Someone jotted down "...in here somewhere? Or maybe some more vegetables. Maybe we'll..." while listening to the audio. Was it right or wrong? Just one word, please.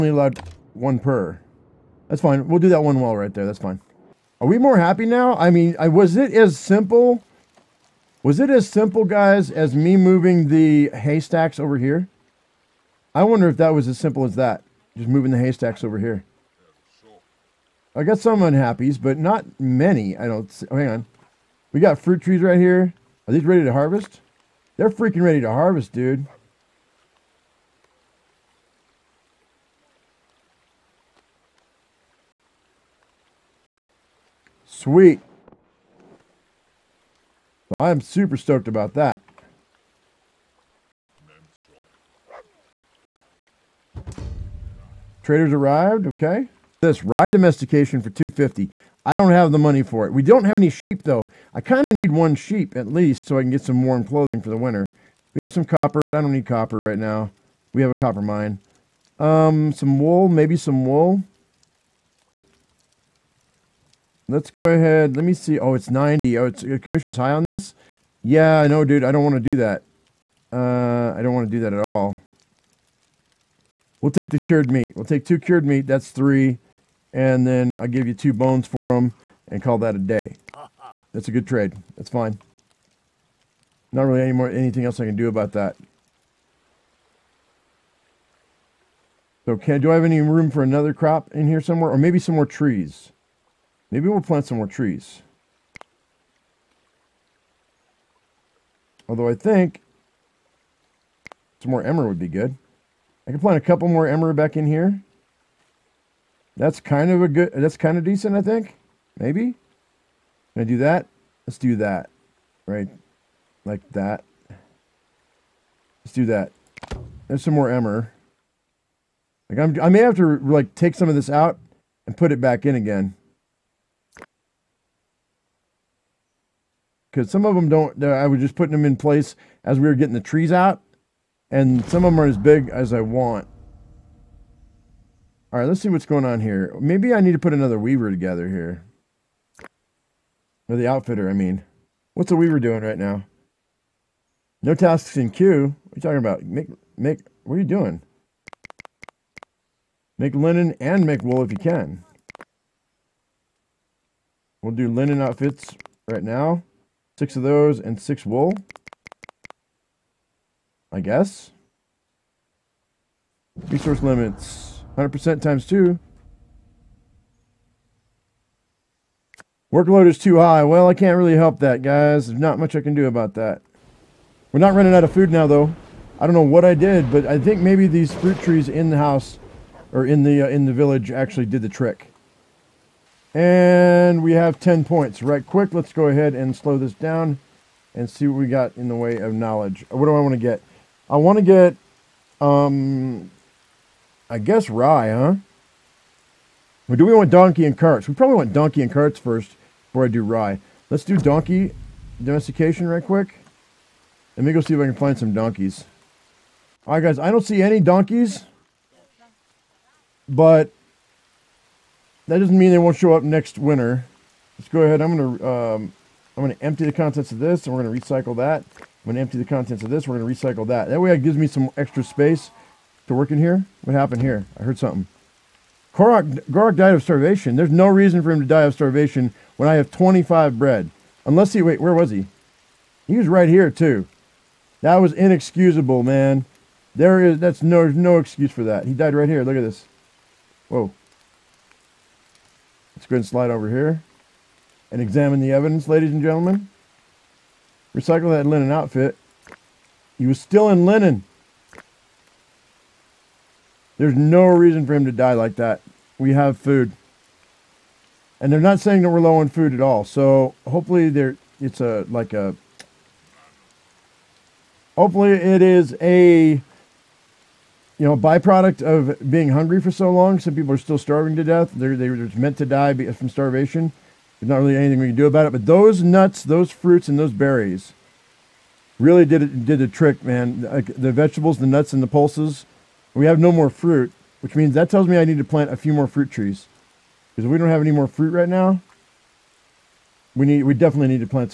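wrong.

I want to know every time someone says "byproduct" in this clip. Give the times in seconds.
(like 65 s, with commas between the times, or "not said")
268 s.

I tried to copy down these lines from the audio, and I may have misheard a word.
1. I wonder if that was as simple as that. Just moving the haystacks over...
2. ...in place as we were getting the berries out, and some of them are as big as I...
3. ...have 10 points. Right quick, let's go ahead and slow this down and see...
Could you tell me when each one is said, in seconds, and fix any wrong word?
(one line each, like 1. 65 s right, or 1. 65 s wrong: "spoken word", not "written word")
1. 13 s right
2. 128 s wrong: "trees", not "berries"
3. 184 s right.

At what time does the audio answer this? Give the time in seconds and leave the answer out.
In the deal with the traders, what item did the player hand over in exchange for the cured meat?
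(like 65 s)
78 s.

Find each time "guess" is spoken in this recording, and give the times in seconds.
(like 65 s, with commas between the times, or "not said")
160 s, 194 s.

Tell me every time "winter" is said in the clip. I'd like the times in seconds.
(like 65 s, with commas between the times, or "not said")
54 s, 213 s.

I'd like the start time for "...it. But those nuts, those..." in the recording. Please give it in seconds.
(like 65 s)
275 s.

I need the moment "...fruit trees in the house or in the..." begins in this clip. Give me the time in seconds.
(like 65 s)
178 s.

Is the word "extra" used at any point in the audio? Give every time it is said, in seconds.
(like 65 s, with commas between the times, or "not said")
221 s.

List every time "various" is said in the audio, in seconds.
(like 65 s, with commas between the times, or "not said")
not said.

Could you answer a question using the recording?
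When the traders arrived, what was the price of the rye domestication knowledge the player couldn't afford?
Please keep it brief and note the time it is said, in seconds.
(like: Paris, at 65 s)
250, at 48 s.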